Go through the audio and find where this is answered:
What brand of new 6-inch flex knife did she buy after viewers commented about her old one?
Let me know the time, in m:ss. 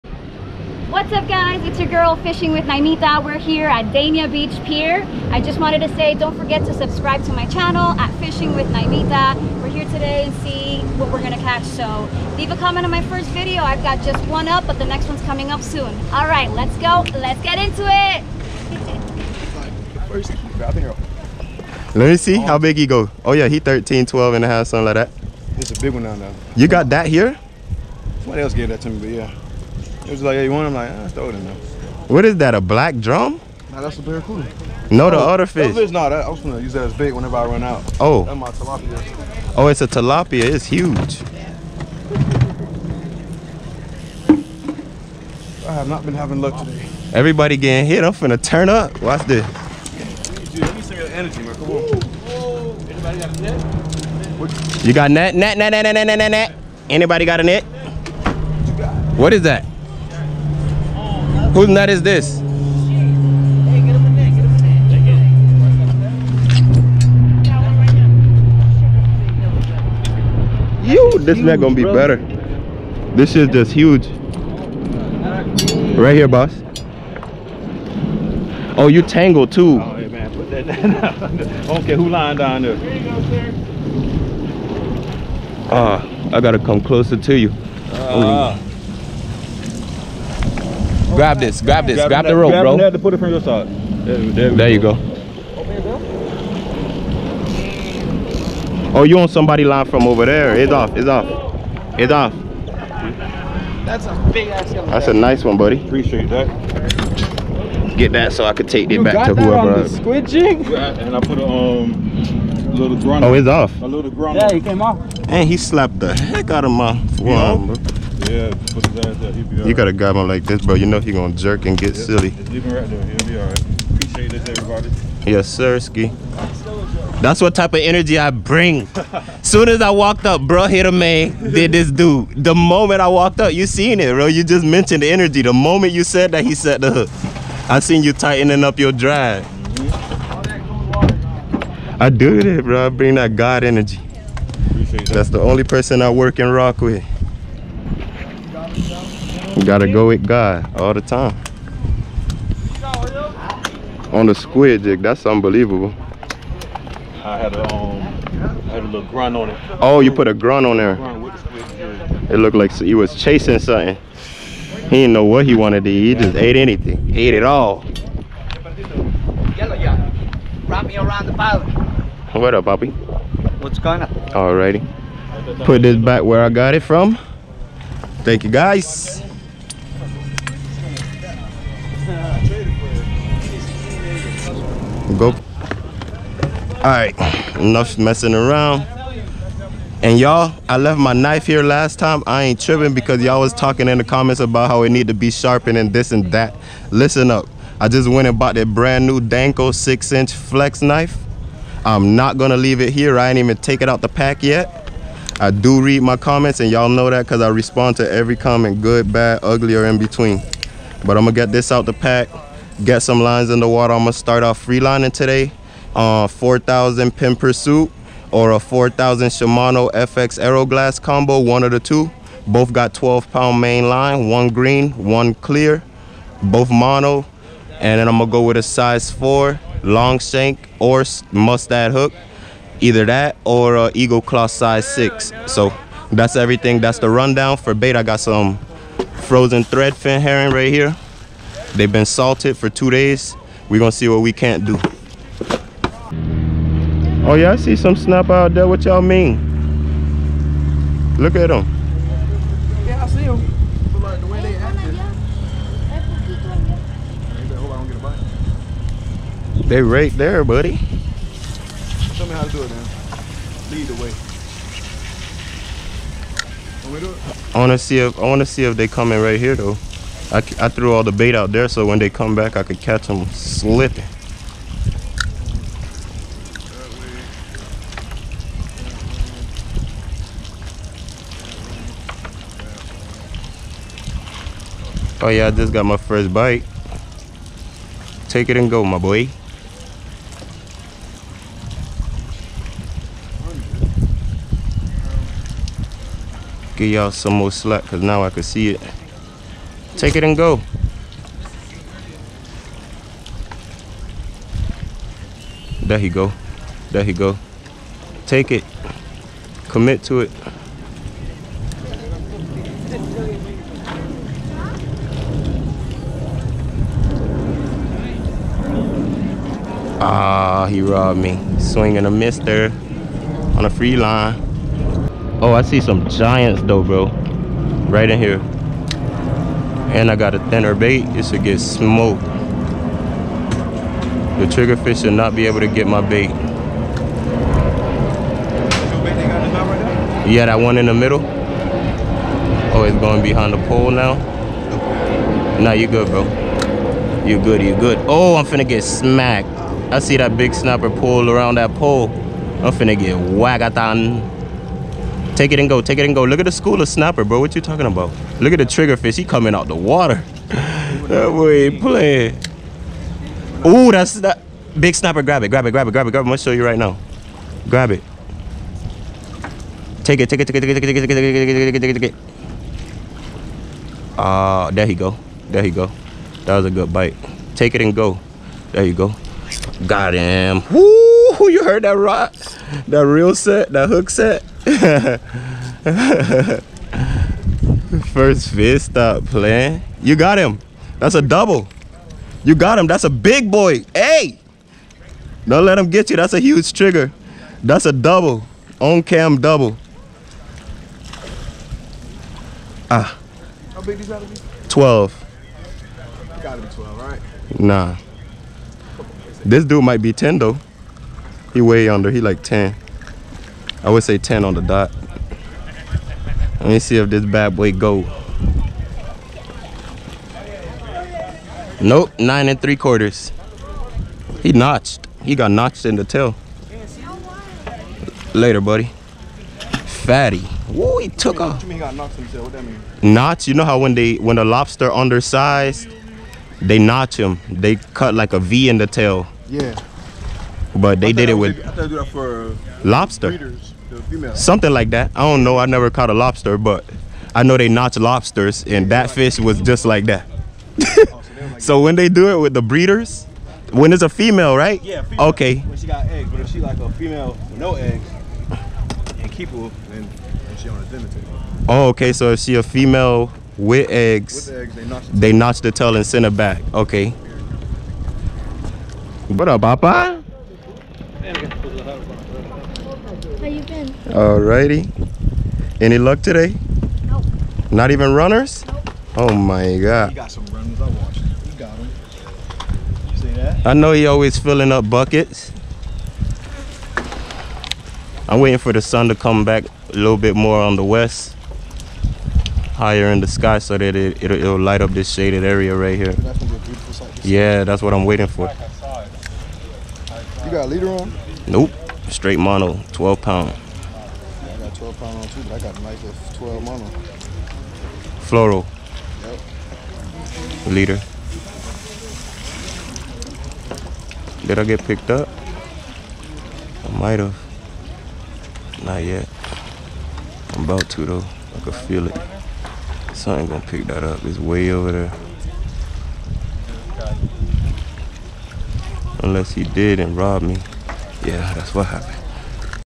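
3:19.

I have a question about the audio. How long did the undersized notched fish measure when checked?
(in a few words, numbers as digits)
9 and 3/4 inches.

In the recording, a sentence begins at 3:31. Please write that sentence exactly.
But I'm gonna get this out the pack get some lines in the water.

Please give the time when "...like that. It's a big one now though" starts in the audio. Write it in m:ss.
0:24.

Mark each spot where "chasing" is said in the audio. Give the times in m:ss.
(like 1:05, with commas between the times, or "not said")
2:43.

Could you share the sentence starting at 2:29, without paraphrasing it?
You gotta go with God all the time.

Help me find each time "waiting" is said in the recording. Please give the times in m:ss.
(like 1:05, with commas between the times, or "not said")
8:08, 8:18.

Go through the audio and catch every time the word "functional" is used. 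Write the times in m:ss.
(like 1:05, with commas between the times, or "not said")
not said.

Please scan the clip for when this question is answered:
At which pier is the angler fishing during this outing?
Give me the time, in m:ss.
0:03.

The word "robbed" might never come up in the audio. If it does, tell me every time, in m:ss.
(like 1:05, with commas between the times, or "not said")
5:20, 8:50.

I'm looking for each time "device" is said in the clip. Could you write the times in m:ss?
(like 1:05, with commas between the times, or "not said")
not said.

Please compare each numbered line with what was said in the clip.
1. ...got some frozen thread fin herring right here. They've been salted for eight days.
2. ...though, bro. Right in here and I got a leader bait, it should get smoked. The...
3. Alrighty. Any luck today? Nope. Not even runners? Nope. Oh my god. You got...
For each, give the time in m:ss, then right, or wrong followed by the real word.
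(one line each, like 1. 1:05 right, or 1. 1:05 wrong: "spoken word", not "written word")
1. 3:58 wrong: "two", not "eight"
2. 5:26 wrong: "thinner", not "leader"
3. 7:54 right.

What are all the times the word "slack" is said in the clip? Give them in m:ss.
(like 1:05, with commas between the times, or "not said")
4:57.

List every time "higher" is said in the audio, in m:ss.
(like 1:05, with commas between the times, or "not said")
8:12.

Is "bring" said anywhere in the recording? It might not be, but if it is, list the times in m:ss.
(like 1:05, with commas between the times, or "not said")
2:08, 2:22.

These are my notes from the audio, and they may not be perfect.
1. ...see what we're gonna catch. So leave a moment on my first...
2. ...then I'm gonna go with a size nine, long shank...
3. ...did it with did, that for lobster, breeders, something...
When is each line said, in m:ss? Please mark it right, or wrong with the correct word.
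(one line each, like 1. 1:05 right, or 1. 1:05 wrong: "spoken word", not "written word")
1. 0:10 wrong: "comment", not "moment"
2. 3:47 wrong: "four", not "nine"
3. 7:21 right.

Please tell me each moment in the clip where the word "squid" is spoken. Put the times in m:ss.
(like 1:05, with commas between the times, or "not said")
1:49, 2:34.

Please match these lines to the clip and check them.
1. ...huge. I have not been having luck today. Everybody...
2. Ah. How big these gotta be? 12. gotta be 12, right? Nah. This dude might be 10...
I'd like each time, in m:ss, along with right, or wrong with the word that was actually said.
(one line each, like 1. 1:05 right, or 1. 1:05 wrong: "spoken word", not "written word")
1. 0:40 right
2. 6:42 right.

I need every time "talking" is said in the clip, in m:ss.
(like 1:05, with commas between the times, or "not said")
3:13, 5:57.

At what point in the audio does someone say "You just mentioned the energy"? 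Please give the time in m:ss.
2:14.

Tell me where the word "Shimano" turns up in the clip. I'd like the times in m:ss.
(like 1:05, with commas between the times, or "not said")
3:39.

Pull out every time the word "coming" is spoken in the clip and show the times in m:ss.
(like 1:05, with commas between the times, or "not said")
0:15, 4:28, 5:59.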